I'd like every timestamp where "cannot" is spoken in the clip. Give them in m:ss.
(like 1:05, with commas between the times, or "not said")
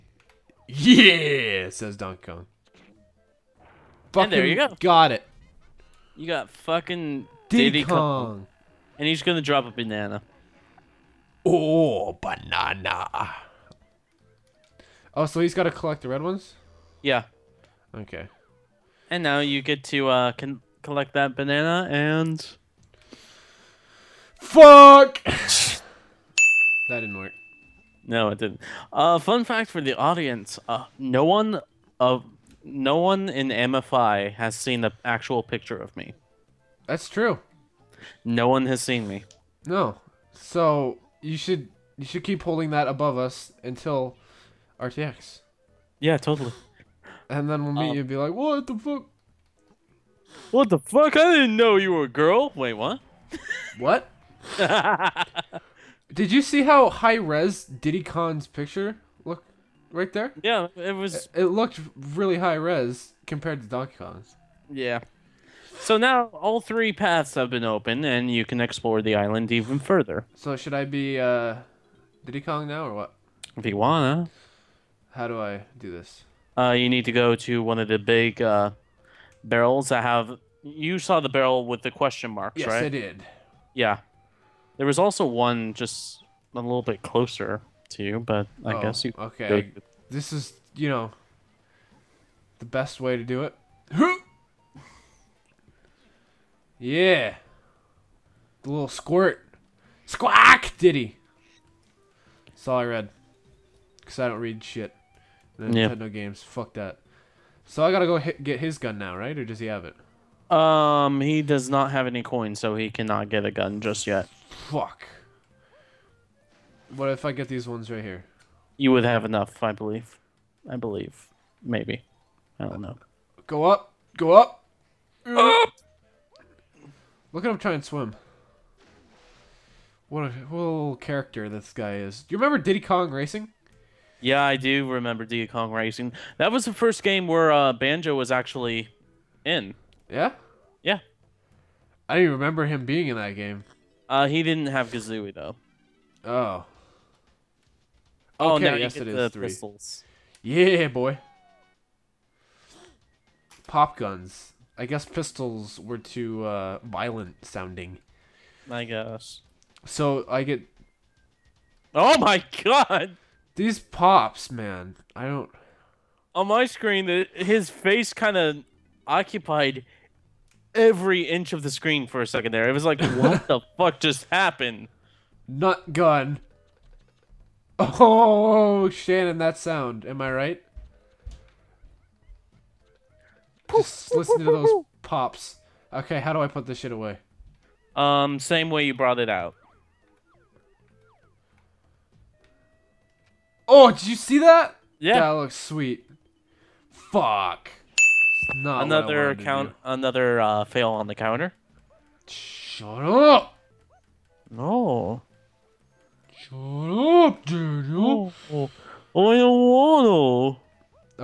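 1:52.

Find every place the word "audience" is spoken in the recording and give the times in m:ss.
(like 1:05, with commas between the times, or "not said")
0:29.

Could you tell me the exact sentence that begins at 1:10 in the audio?
So should I be uh, Diddy Kong now or what?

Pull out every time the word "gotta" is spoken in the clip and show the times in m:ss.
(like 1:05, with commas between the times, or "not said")
0:15, 1:47.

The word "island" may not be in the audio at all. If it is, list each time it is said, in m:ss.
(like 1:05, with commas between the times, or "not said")
1:09.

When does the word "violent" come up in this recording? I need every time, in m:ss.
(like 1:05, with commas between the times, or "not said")
2:36.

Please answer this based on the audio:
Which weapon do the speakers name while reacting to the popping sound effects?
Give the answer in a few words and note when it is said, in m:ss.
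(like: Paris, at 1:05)
Nut gun, at 2:55.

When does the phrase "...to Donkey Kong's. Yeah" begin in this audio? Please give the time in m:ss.
1:03.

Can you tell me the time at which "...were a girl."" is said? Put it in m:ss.
0:51.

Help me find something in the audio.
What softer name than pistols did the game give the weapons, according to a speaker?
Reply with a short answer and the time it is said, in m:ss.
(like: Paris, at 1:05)
Pop guns, at 2:33.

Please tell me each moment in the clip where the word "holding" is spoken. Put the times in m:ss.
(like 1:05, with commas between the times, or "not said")
0:42.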